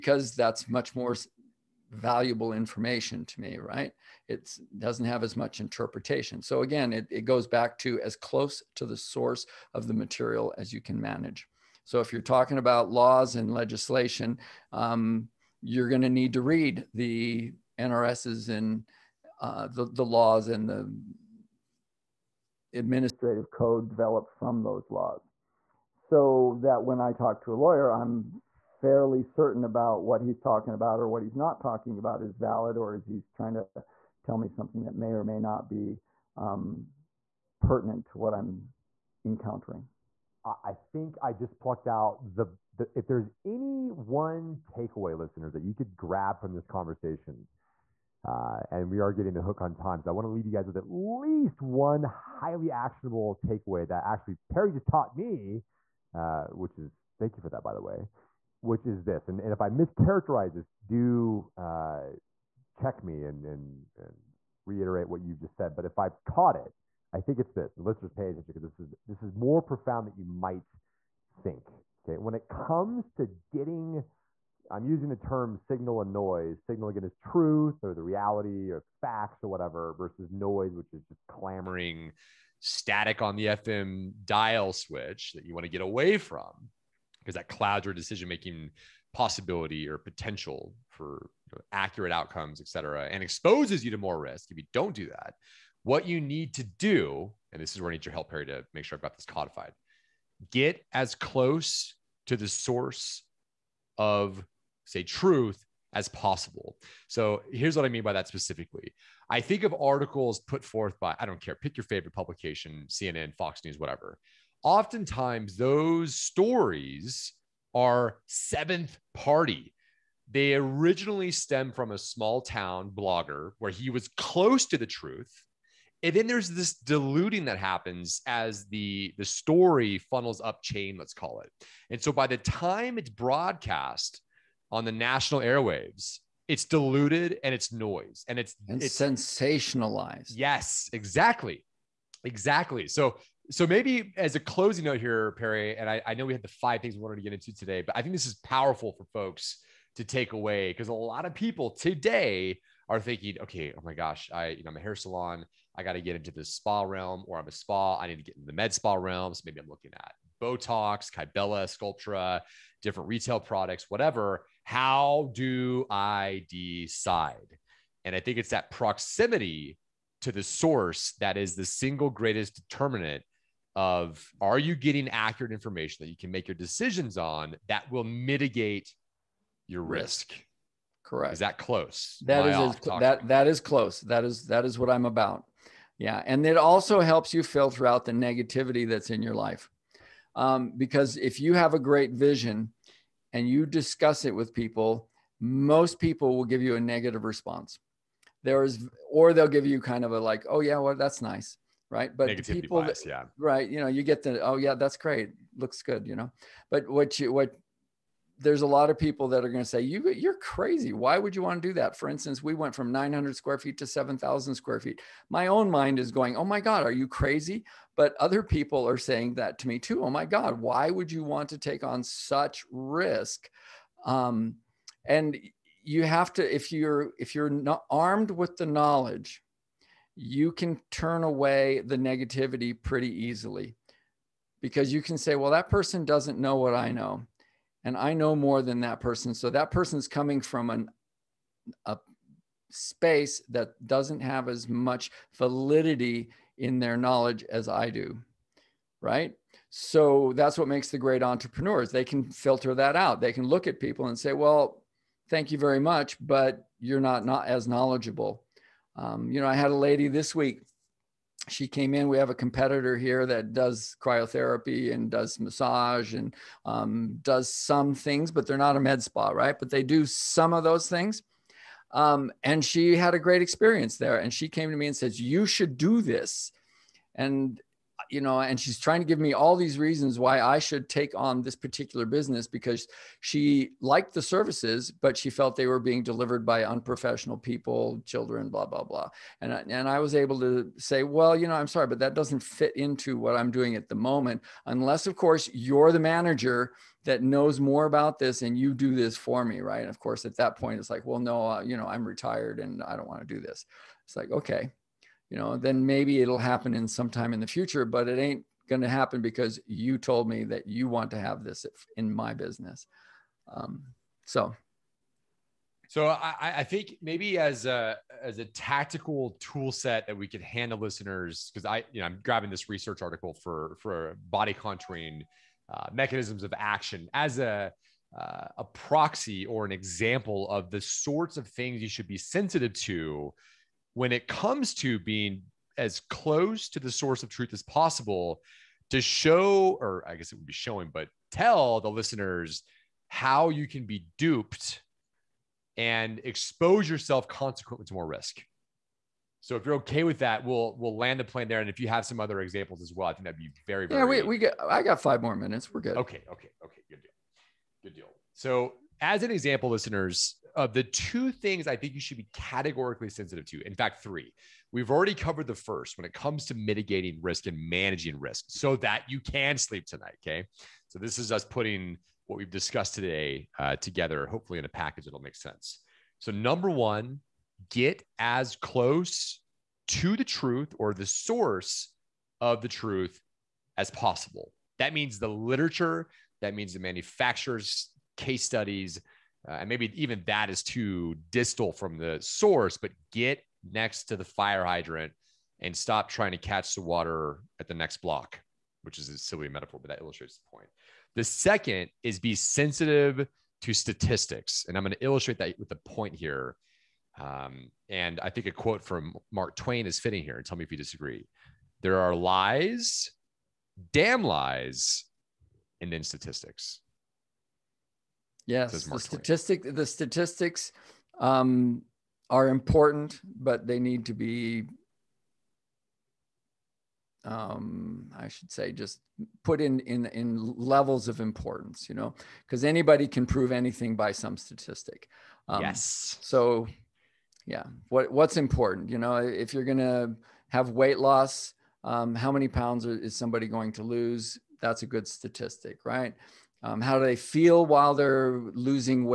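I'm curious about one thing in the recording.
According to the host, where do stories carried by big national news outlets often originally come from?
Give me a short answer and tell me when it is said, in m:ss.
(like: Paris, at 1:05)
a small town blogger, at 2:01.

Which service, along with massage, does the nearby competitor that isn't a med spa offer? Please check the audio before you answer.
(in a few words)
cryotherapy.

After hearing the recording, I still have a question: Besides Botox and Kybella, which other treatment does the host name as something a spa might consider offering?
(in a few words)
Sculptra.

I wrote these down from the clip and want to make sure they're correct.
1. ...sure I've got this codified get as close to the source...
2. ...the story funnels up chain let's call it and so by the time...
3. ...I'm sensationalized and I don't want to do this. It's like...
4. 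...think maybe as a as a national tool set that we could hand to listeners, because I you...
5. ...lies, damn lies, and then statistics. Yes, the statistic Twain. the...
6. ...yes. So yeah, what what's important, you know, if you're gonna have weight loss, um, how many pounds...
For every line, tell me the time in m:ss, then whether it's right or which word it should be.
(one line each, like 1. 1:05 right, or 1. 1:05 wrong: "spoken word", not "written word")
1. 1:38 right
2. 2:09 right
3. 5:01 wrong: "retired", not "sensationalized"
4. 5:16 wrong: "tactical", not "national"
5. 6:52 right
6. 7:15 right.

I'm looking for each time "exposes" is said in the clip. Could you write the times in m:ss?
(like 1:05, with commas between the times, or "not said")
1:33, 5:46.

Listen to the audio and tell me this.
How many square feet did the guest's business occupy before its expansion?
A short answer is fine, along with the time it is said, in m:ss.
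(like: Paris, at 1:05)
900, at 3:32.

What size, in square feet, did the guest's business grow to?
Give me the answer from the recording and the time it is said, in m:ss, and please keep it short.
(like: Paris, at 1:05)
7000, at 3:33.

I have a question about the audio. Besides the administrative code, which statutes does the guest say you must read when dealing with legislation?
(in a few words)
NRSs.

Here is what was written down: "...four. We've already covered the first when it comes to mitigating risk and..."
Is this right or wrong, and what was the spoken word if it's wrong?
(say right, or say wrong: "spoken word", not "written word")
wrong: "three", not "four".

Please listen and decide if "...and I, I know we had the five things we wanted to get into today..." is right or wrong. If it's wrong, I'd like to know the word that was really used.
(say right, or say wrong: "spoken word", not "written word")
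right.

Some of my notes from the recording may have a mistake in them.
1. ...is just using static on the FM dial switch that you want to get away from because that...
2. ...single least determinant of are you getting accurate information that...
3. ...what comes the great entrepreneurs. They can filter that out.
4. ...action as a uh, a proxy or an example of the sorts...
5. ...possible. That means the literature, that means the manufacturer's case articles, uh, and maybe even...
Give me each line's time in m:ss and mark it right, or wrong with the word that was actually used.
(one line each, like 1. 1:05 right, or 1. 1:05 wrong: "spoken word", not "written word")
1. 1:20 wrong: "clamoring", not "using"
2. 2:51 wrong: "greatest", not "least"
3. 4:10 wrong: "makes", not "comes"
4. 5:26 right
5. 6:23 wrong: "studies", not "articles".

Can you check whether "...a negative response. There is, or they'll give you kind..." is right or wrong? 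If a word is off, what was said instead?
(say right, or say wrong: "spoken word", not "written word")
right.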